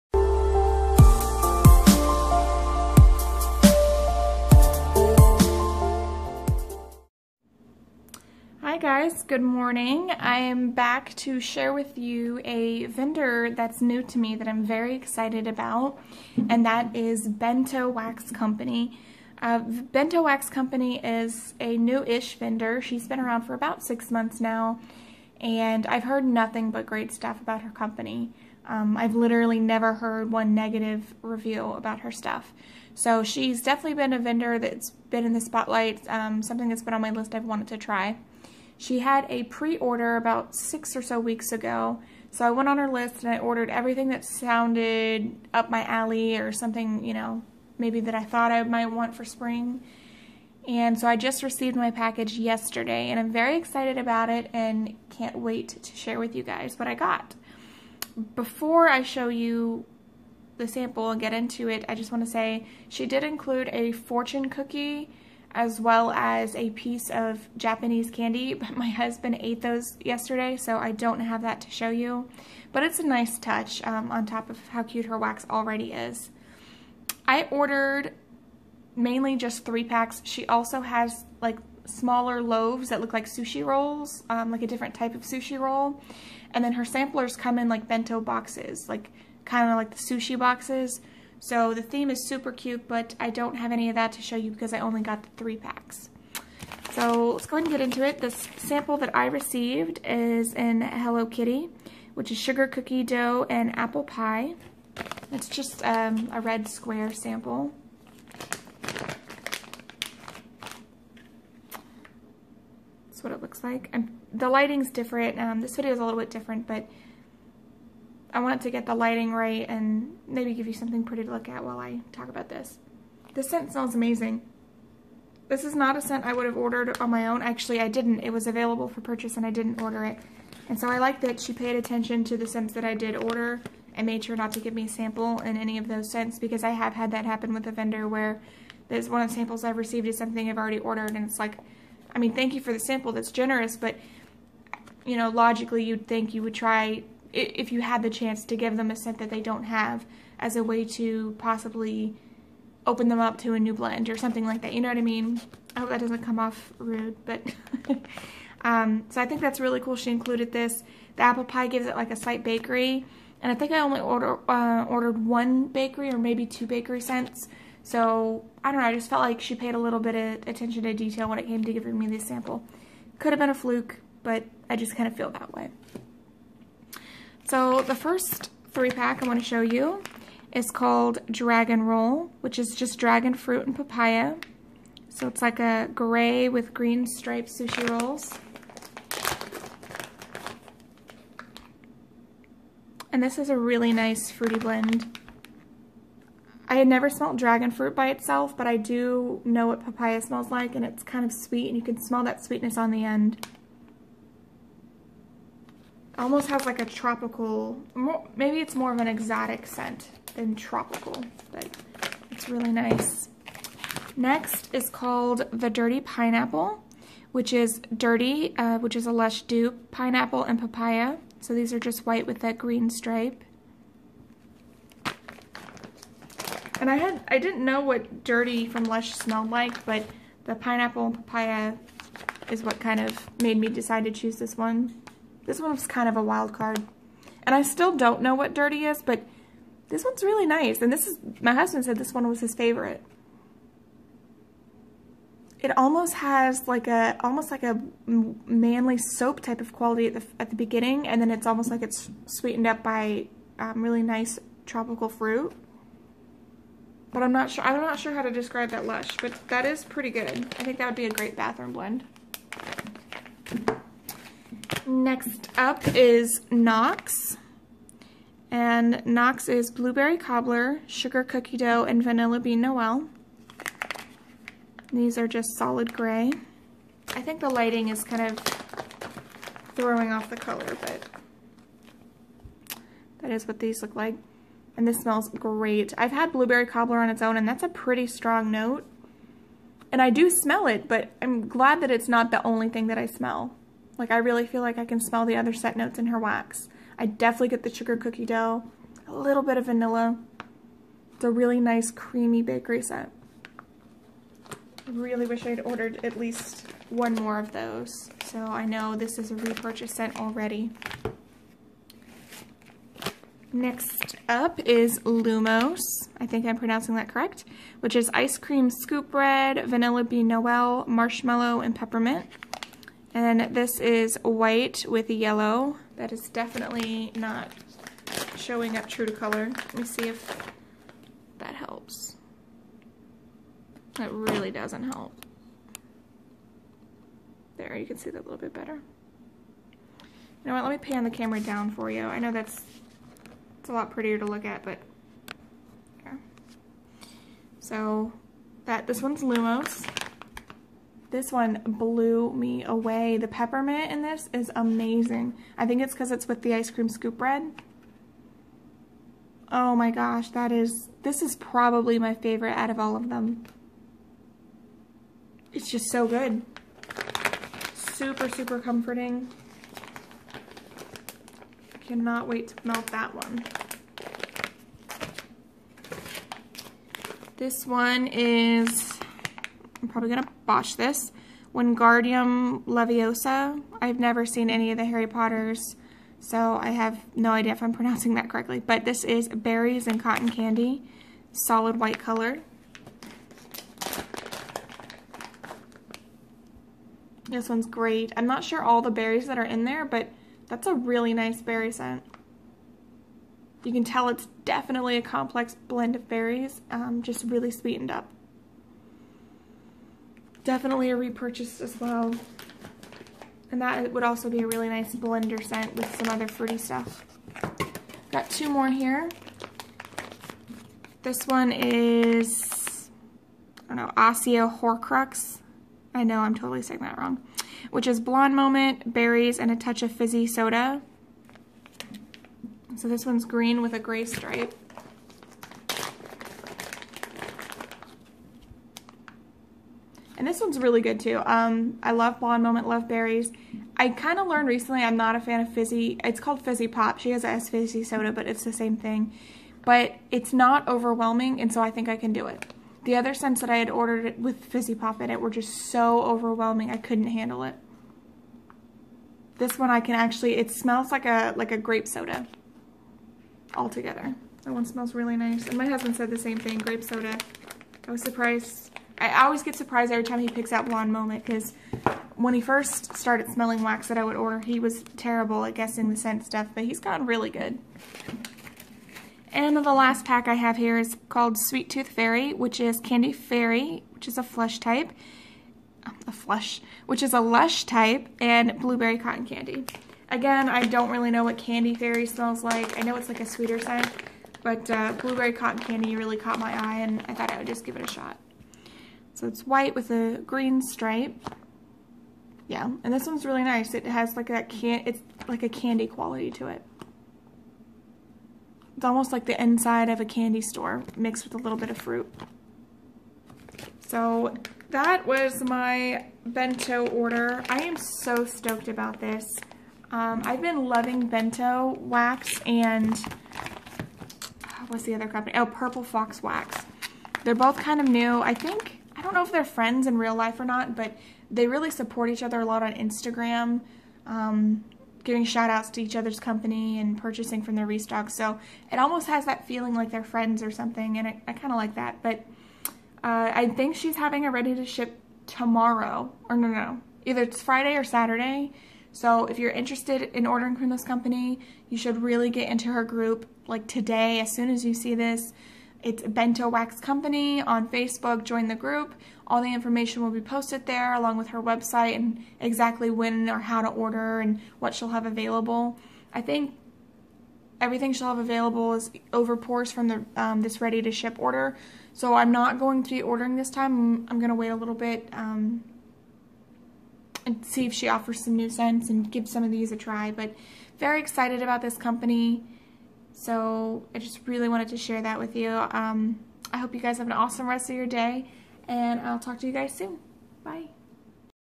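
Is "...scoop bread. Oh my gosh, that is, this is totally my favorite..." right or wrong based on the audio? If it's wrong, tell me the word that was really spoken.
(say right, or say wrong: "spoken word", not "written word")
wrong: "probably", not "totally".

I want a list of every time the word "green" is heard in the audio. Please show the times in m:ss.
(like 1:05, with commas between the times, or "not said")
3:06, 3:42, 7:13, 8:20.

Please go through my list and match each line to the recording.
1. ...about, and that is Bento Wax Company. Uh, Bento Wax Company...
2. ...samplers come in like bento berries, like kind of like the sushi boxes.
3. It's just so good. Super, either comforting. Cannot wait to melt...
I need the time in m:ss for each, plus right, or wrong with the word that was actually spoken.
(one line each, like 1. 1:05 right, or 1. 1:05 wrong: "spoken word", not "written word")
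1. 0:15 right
2. 1:26 wrong: "boxes", not "berries"
3. 6:05 wrong: "super", not "either".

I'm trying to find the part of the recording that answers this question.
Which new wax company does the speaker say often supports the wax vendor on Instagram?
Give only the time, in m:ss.
8:45.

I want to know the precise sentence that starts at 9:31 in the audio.
So I'm not going to be ordering this time.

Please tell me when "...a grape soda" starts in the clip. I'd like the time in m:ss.
7:41.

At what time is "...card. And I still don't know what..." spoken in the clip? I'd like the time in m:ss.
3:56.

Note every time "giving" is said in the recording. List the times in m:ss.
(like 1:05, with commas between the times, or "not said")
2:51, 8:55.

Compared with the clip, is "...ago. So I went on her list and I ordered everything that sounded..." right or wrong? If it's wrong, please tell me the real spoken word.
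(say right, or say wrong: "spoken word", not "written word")
right.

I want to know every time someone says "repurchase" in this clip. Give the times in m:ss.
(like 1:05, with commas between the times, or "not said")
5:09, 6:50.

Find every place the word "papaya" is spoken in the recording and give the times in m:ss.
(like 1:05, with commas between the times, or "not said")
3:03, 3:19, 3:40, 3:51.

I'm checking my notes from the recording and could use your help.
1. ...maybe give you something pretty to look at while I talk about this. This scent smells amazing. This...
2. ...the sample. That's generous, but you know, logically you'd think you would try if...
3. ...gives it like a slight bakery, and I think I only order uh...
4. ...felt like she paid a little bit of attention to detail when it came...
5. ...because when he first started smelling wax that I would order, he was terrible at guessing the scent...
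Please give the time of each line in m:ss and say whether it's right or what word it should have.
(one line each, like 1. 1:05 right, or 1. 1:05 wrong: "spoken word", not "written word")
1. 2:00 right
2. 2:22 right
3. 2:41 right
4. 2:49 right
5. 7:51 right.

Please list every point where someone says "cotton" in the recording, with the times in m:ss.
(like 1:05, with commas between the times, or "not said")
6:30, 8:08, 8:15.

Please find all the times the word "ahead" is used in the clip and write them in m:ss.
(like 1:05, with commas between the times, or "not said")
1:37.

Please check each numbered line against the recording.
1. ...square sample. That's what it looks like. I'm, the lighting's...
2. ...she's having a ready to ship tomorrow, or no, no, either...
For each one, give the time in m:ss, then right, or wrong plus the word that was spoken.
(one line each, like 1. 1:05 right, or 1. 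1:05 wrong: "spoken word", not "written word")
1. 1:46 right
2. 9:03 right.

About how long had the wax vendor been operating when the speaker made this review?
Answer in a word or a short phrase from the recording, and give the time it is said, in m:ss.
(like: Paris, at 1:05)
6 months, at 0:23.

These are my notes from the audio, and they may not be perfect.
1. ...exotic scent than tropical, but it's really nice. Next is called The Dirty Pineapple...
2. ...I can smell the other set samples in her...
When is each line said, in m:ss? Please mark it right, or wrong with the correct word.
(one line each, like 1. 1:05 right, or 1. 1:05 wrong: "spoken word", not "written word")
1. 3:29 right
2. 4:54 wrong: "notes", not "samples".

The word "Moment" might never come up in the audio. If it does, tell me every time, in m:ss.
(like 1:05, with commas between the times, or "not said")
7:08, 7:22, 7:50.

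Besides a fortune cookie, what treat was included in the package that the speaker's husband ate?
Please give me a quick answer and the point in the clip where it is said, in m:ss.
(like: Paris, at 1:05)
Japanese candy, at 1:07.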